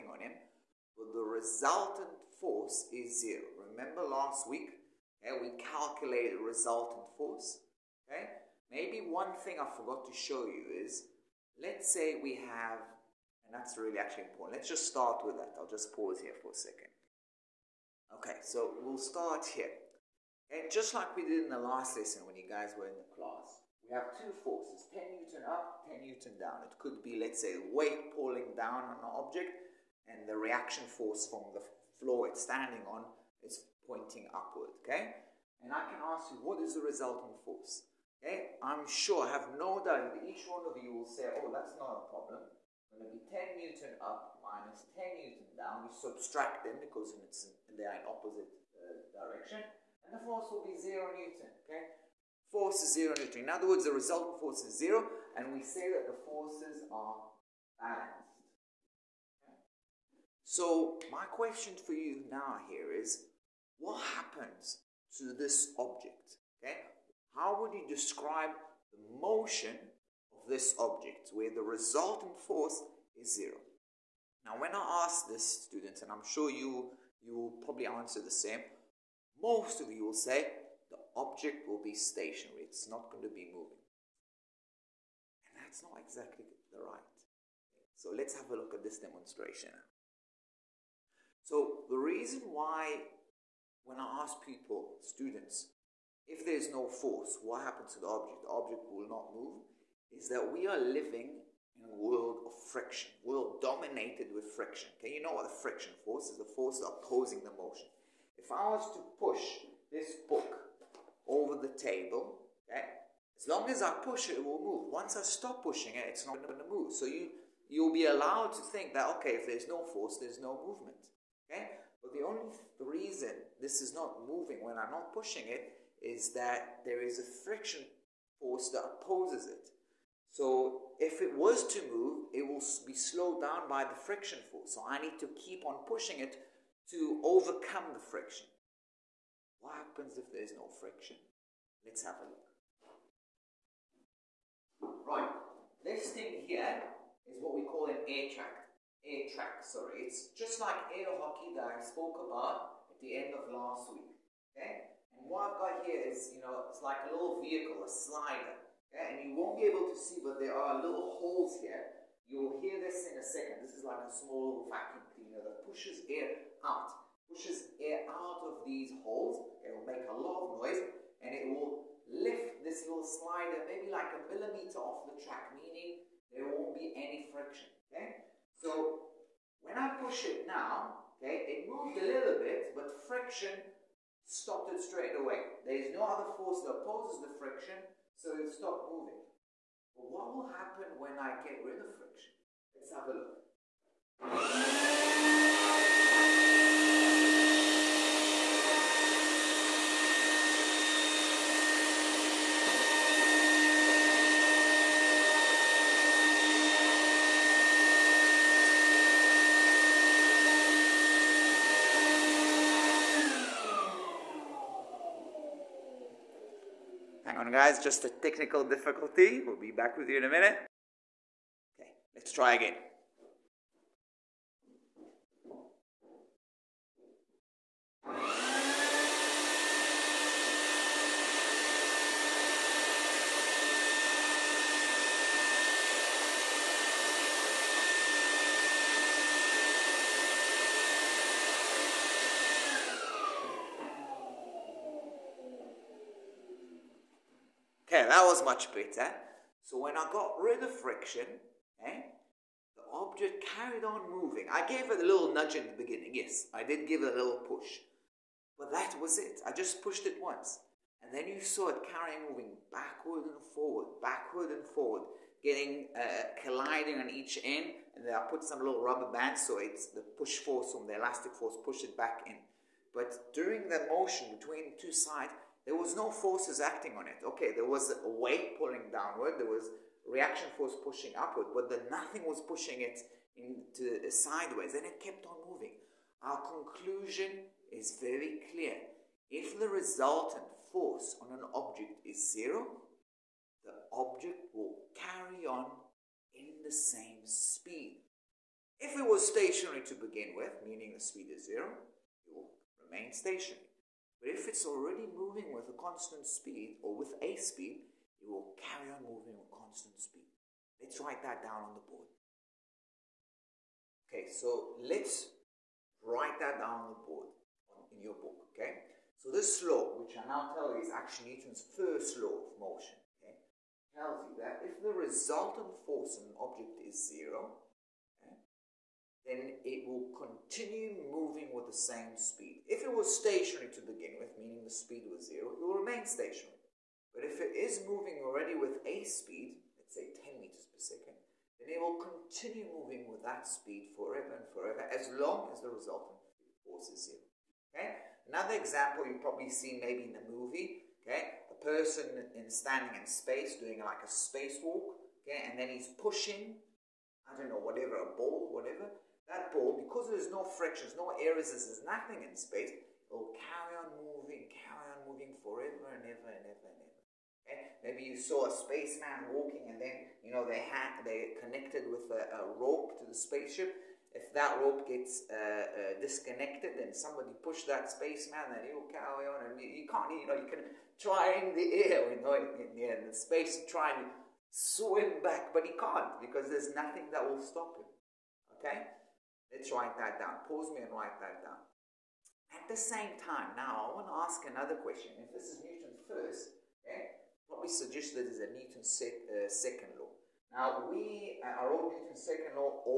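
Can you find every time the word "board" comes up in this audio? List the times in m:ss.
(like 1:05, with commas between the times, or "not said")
5:11, 5:17.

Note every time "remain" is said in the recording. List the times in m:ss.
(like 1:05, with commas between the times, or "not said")
5:02, 5:35.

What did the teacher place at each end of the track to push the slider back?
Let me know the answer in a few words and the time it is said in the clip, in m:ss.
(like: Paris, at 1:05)
rubber bands, at 4:28.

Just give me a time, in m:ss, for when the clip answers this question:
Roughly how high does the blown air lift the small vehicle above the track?
2:53.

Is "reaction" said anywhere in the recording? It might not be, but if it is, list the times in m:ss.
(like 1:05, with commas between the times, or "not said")
0:30, 4:40.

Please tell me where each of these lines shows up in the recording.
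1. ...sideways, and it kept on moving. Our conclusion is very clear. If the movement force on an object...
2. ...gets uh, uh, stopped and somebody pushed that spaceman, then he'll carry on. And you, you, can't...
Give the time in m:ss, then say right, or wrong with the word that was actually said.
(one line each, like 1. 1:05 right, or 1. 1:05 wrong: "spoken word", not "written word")
1. 4:44 wrong: "resultant", not "movement"
2. 6:14 wrong: "disconnected", not "stopped".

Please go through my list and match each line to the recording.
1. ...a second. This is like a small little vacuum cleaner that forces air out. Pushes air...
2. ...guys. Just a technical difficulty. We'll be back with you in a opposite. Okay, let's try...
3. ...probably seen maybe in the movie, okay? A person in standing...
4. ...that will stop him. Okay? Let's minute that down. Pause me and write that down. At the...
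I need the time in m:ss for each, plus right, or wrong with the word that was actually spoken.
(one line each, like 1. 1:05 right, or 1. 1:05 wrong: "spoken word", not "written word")
1. 2:43 wrong: "pushes", not "forces"
2. 3:37 wrong: "minute", not "opposite"
3. 5:49 right
4. 6:27 wrong: "write", not "minute".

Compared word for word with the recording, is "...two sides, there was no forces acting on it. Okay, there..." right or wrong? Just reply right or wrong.
right.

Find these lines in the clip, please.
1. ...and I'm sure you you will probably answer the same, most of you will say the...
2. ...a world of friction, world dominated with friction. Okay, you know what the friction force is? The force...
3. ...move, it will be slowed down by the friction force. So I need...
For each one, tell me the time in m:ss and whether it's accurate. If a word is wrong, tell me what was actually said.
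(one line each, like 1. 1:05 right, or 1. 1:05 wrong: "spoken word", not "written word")
1. 1:16 right
2. 1:41 right
3. 2:11 right.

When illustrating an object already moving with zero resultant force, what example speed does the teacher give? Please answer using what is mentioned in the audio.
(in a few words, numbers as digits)
10 meters per second.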